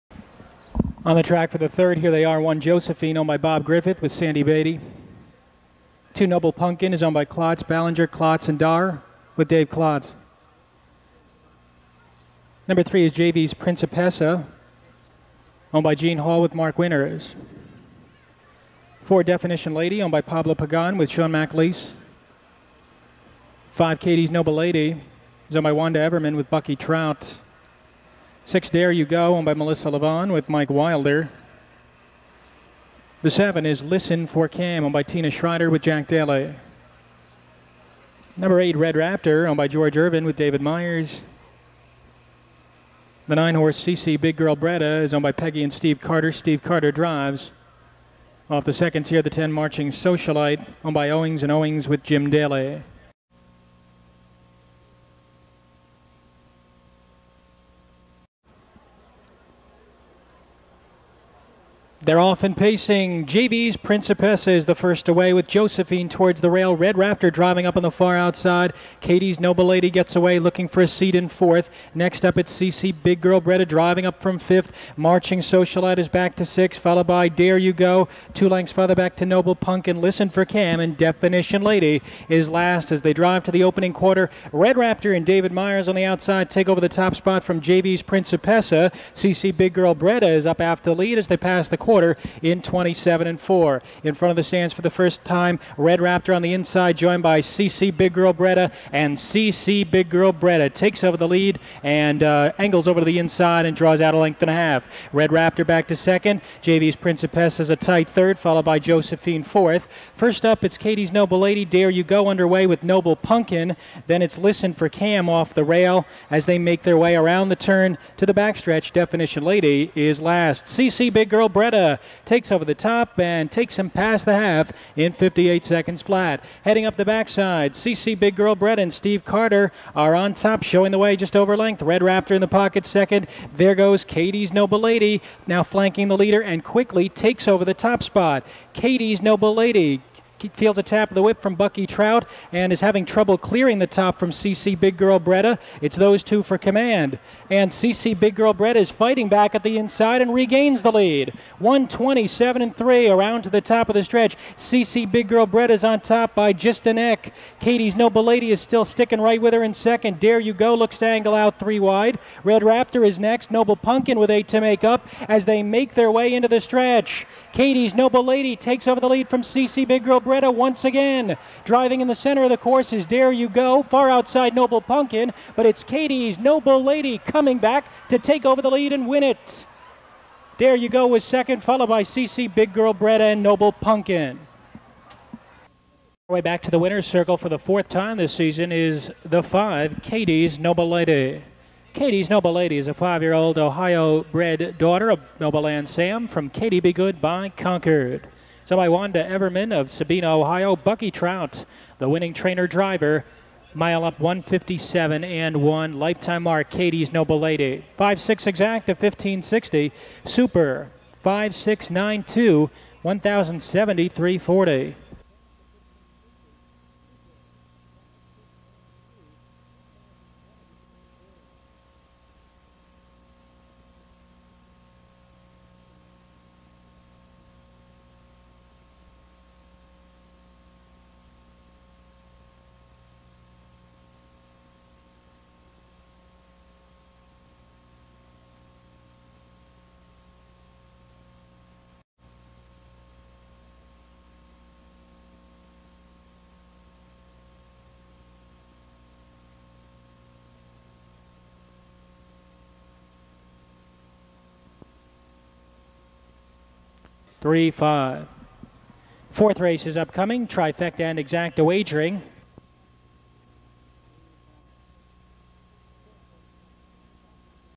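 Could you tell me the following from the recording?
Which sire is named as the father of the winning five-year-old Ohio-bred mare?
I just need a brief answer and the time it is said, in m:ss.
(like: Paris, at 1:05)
Nobleland Sam, at 3:15.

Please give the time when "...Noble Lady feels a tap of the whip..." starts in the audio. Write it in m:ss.
2:19.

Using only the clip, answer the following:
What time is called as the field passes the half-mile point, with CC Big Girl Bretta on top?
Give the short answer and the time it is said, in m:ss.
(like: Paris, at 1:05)
58 seconds flat, at 2:05.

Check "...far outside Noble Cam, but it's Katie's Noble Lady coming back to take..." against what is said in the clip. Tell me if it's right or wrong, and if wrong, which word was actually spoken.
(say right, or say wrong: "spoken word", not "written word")
wrong: "Pumpkin", not "Cam".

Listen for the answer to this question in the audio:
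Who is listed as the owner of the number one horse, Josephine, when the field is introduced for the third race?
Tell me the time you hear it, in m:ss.
0:03.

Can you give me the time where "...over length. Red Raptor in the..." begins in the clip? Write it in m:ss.
2:11.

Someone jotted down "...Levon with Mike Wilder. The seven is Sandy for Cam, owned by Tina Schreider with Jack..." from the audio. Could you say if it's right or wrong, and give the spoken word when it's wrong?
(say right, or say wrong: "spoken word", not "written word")
wrong: "Listen", not "Sandy".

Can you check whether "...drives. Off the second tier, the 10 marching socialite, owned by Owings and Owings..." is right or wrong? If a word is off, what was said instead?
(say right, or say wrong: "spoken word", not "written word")
right.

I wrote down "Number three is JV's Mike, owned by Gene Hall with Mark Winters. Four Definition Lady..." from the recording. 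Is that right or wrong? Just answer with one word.
wrong.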